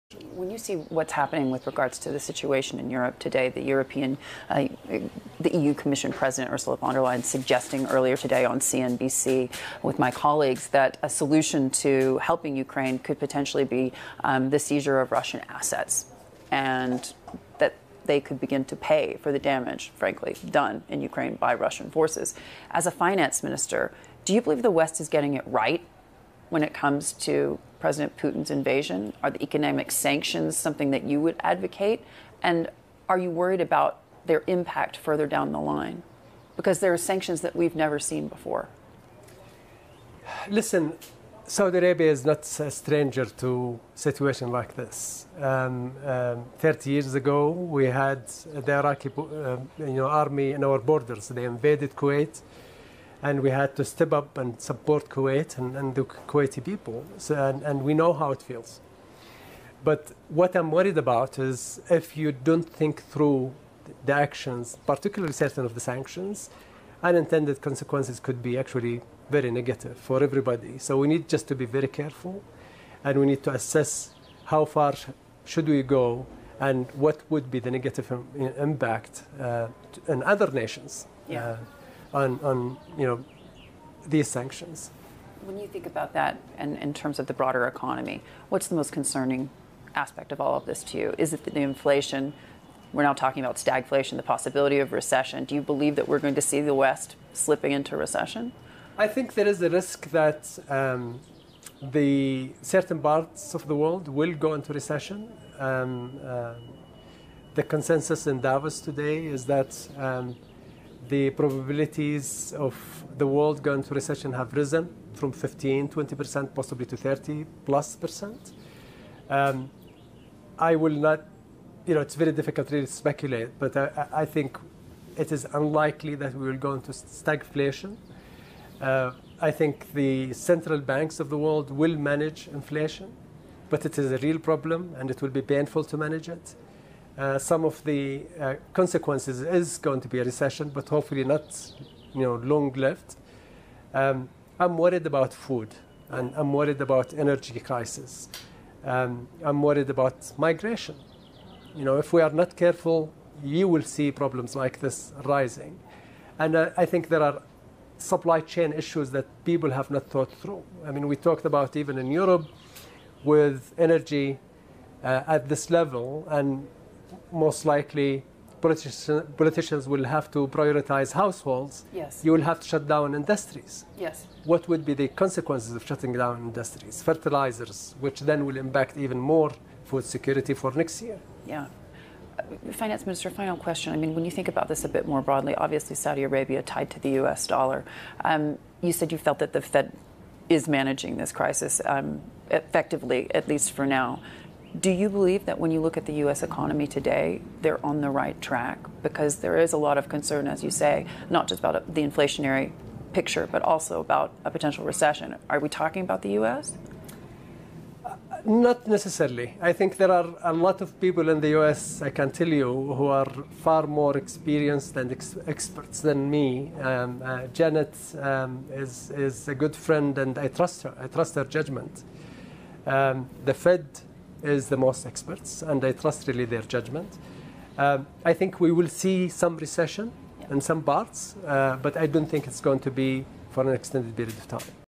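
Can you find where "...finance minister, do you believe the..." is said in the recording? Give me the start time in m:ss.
0:22.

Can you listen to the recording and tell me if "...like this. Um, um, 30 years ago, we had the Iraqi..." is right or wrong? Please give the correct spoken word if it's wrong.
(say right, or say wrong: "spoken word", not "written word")
right.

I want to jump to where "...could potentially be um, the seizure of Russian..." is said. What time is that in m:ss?
0:12.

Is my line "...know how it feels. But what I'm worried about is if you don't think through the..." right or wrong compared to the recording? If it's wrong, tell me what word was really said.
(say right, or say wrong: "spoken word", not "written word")
right.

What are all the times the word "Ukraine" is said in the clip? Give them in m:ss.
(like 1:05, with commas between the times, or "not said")
0:12, 0:21.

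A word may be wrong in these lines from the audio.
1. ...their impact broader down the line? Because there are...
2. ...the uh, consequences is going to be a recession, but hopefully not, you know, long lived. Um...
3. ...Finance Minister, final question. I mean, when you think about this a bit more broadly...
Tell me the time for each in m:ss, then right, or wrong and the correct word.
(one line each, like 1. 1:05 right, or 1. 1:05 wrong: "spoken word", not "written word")
1. 0:34 wrong: "further", not "broader"
2. 2:17 right
3. 3:02 right.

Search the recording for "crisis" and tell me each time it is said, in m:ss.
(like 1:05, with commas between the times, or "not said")
2:27, 3:11.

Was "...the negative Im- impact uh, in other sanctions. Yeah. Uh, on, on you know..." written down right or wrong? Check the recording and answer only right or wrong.
wrong.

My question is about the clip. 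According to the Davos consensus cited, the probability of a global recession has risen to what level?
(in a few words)
30 plus percent.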